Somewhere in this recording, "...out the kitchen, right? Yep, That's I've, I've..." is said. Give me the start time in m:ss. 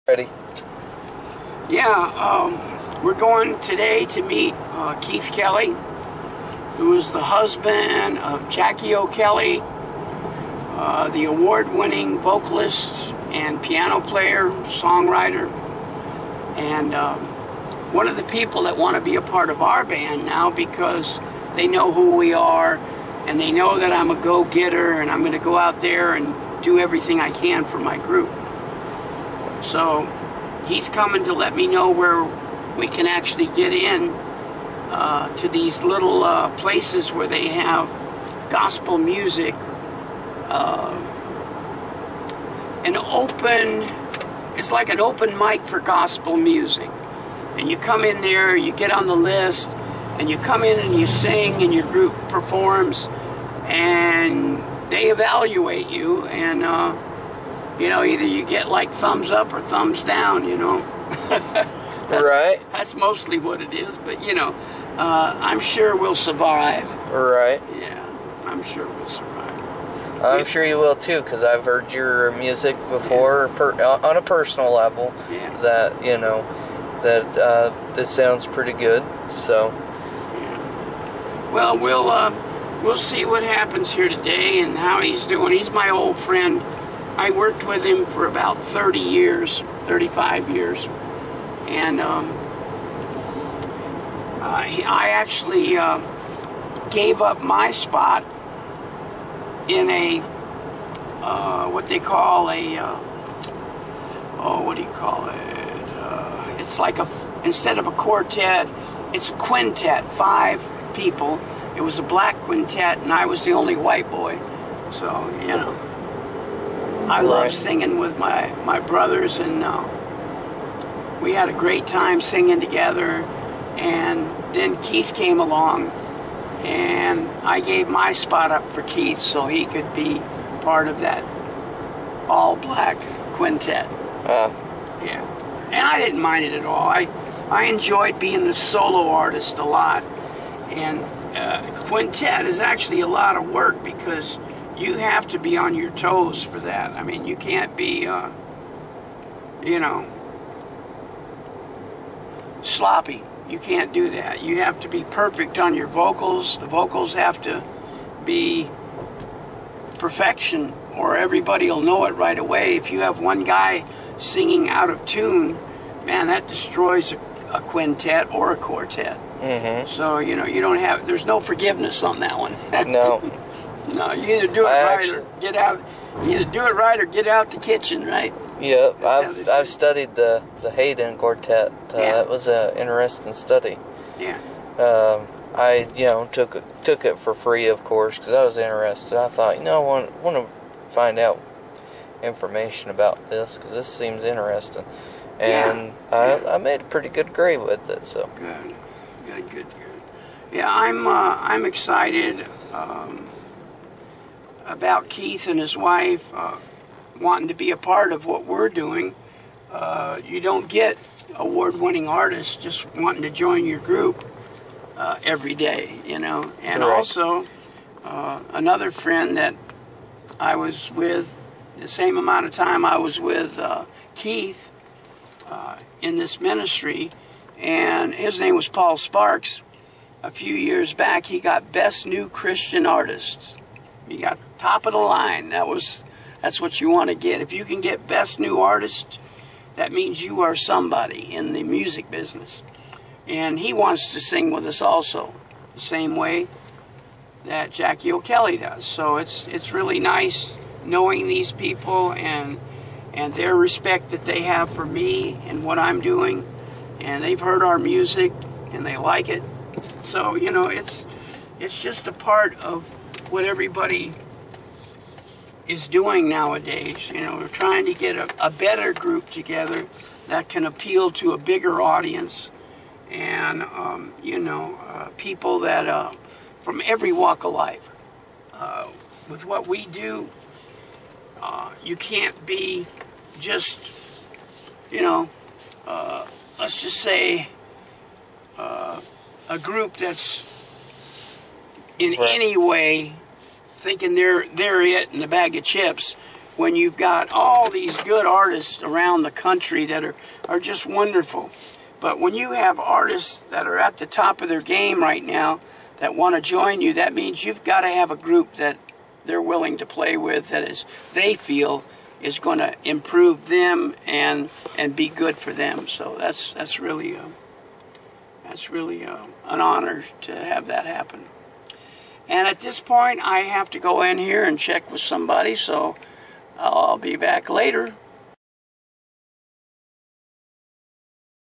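2:57.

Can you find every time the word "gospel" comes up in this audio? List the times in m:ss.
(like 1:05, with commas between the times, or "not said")
0:38, 0:45.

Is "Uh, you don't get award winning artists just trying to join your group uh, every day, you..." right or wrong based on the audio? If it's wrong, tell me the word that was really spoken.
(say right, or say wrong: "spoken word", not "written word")
wrong: "wanting", not "trying".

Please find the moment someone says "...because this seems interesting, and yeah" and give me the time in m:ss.
3:13.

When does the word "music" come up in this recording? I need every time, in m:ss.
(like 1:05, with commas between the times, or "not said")
0:38, 0:46, 1:12, 4:01, 4:17.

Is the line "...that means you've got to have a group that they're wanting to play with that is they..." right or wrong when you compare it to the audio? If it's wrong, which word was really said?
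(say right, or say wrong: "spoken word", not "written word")
wrong: "willing", not "wanting".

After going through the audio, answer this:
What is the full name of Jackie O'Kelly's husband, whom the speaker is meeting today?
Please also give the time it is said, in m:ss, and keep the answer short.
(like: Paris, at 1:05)
Keith Kelly, at 0:04.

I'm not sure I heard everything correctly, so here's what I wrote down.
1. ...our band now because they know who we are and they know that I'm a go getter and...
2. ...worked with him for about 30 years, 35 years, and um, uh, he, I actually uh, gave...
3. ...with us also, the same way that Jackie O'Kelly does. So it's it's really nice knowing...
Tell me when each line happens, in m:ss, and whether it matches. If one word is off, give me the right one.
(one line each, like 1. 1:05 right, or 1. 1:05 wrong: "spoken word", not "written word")
1. 0:19 right
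2. 1:27 right
3. 4:04 right.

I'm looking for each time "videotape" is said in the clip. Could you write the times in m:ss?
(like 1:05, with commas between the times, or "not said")
not said.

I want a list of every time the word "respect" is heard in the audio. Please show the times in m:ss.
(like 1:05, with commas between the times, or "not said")
4:13.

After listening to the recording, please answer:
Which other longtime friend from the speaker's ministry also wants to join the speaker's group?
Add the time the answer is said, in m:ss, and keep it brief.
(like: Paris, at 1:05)
Paul Sparks, at 3:48.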